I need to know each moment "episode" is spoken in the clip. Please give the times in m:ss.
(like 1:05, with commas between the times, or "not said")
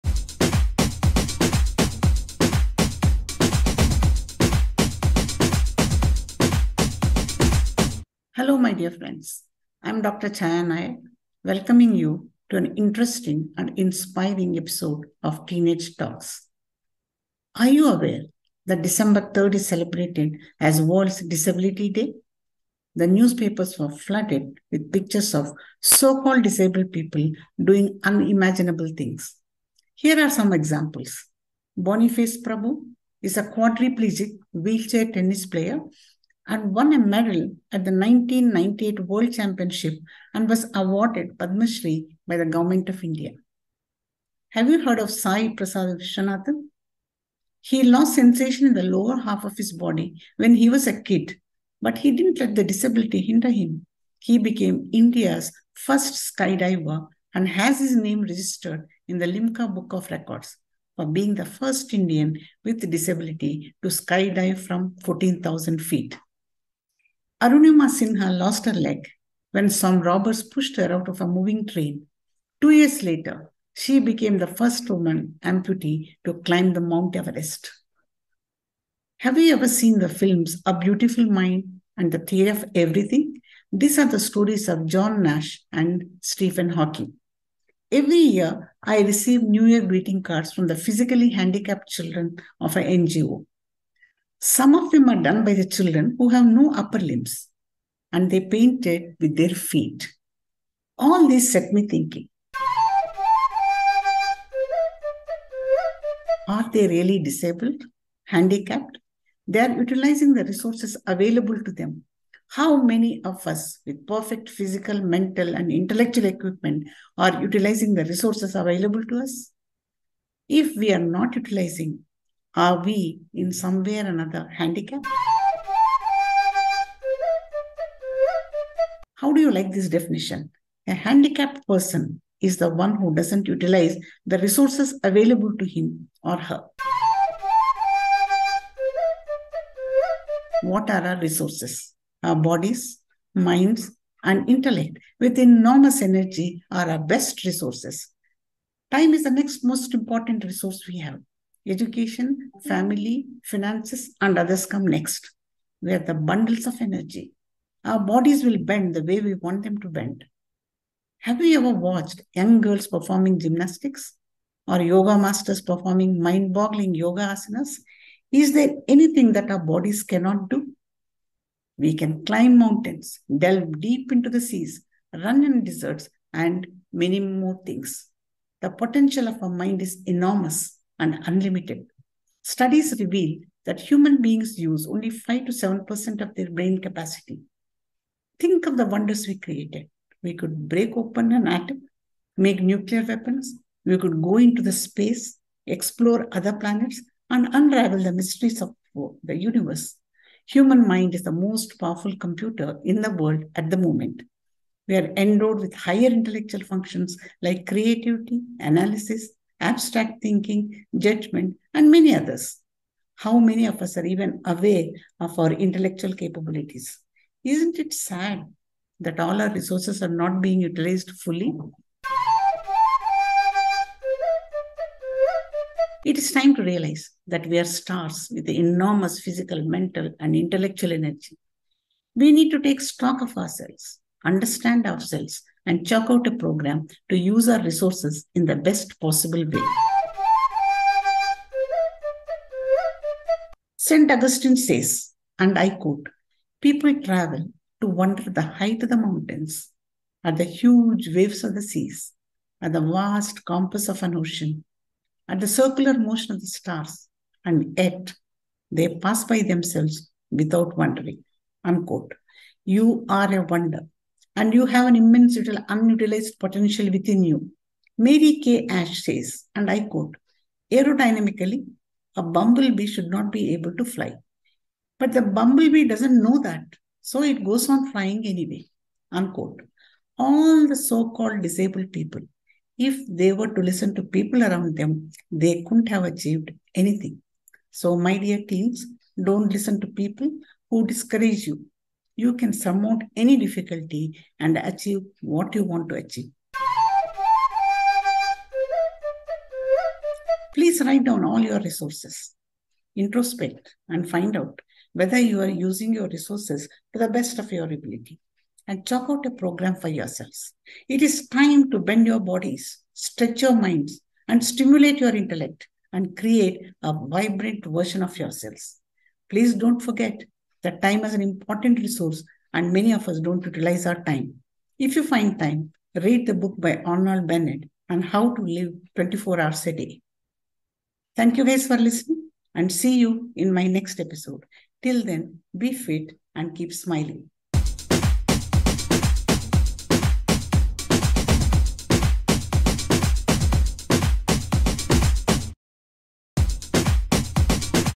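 0:14, 5:33.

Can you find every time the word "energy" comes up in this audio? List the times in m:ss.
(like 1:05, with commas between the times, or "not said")
2:26, 2:36, 3:50.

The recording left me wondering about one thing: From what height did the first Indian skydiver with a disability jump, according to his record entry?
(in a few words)
14,000 feet.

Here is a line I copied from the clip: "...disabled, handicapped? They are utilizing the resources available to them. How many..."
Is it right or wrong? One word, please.
right.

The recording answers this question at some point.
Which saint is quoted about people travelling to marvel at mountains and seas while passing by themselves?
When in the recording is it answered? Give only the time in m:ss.
4:03.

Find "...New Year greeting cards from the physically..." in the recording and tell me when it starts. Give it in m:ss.
1:29.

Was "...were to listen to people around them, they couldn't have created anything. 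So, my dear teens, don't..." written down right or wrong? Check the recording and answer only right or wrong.
wrong.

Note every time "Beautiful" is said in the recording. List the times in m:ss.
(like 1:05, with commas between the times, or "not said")
1:20.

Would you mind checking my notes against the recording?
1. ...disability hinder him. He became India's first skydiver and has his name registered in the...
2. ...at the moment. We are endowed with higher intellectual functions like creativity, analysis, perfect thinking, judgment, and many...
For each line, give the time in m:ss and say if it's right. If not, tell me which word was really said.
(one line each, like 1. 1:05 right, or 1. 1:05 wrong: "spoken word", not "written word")
1. 0:52 right
2. 3:23 wrong: "abstract", not "perfect".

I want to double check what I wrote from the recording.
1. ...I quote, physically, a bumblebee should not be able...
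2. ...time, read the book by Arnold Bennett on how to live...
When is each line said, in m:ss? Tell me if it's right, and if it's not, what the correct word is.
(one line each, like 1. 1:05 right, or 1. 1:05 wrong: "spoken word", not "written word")
1. 4:29 wrong: "aerodynamically", not "physically"
2. 5:25 right.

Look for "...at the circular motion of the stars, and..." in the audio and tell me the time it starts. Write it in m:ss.
4:15.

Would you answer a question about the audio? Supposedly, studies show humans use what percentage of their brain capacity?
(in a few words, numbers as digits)
5 to 7%.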